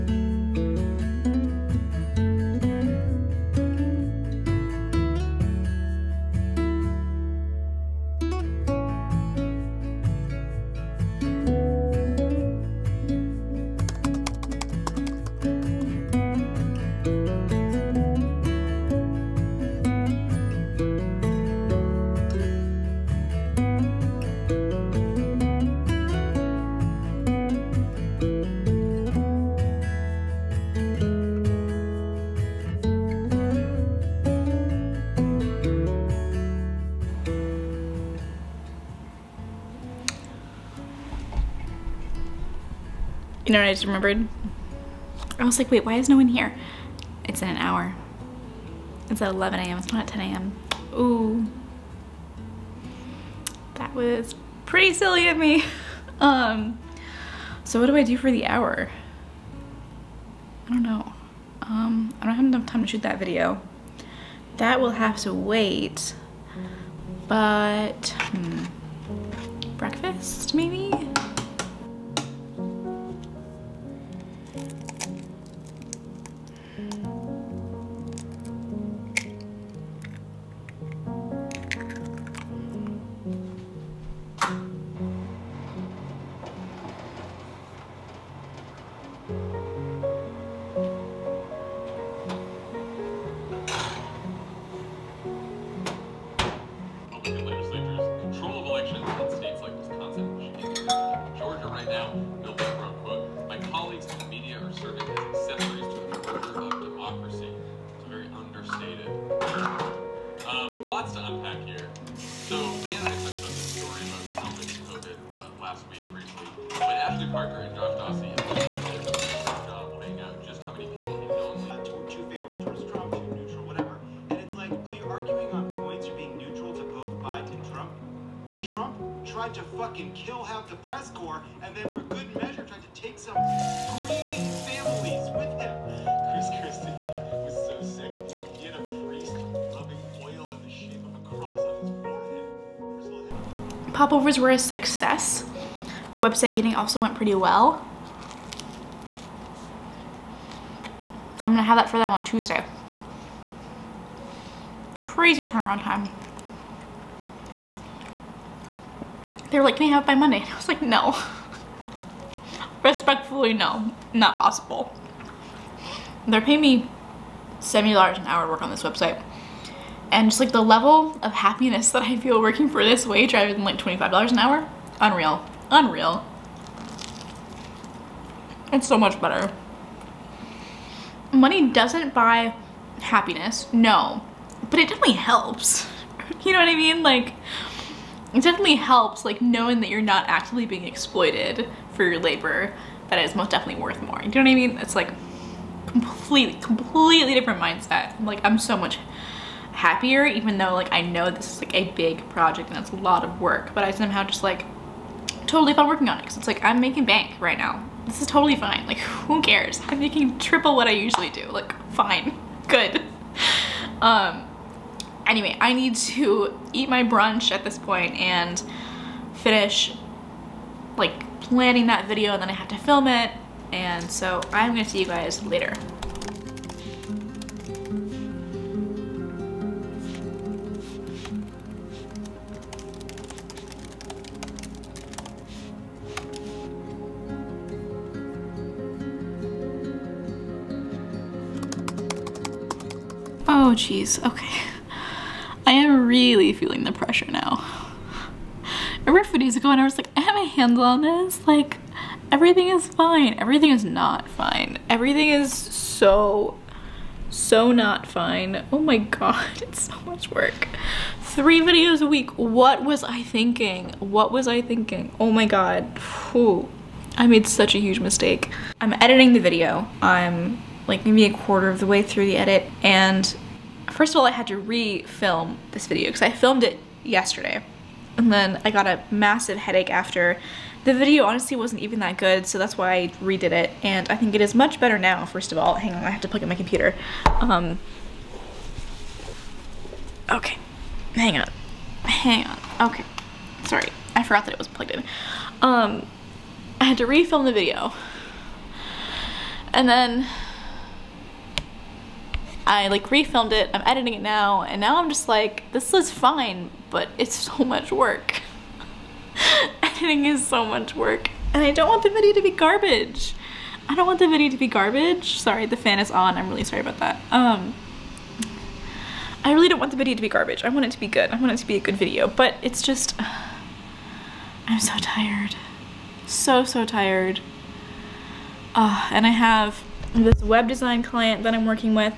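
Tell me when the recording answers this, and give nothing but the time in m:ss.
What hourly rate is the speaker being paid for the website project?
2:47.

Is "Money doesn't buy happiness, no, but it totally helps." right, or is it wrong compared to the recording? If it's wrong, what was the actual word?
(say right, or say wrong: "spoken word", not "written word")
wrong: "definitely", not "totally".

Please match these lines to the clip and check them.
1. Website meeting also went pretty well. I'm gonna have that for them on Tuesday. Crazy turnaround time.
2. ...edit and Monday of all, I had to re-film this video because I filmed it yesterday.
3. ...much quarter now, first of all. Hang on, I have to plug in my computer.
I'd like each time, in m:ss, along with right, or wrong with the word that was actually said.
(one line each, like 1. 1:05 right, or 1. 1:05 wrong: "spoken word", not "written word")
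1. 2:26 right
2. 4:32 wrong: "First", not "Monday"
3. 4:44 wrong: "better", not "quarter".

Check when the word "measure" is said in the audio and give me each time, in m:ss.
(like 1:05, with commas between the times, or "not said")
2:12.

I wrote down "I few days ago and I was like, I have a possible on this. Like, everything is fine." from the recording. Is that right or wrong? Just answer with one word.
wrong.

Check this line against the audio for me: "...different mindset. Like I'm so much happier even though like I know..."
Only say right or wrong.
right.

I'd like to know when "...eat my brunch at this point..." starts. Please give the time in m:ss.
3:36.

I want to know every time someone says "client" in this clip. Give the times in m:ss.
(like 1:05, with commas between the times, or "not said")
5:31.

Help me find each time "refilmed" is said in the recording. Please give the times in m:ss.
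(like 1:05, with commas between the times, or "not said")
5:03.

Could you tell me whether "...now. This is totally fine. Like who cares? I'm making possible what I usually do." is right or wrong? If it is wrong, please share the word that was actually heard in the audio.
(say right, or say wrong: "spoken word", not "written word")
wrong: "triple", not "possible".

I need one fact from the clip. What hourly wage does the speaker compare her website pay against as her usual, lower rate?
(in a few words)
$25 an hour.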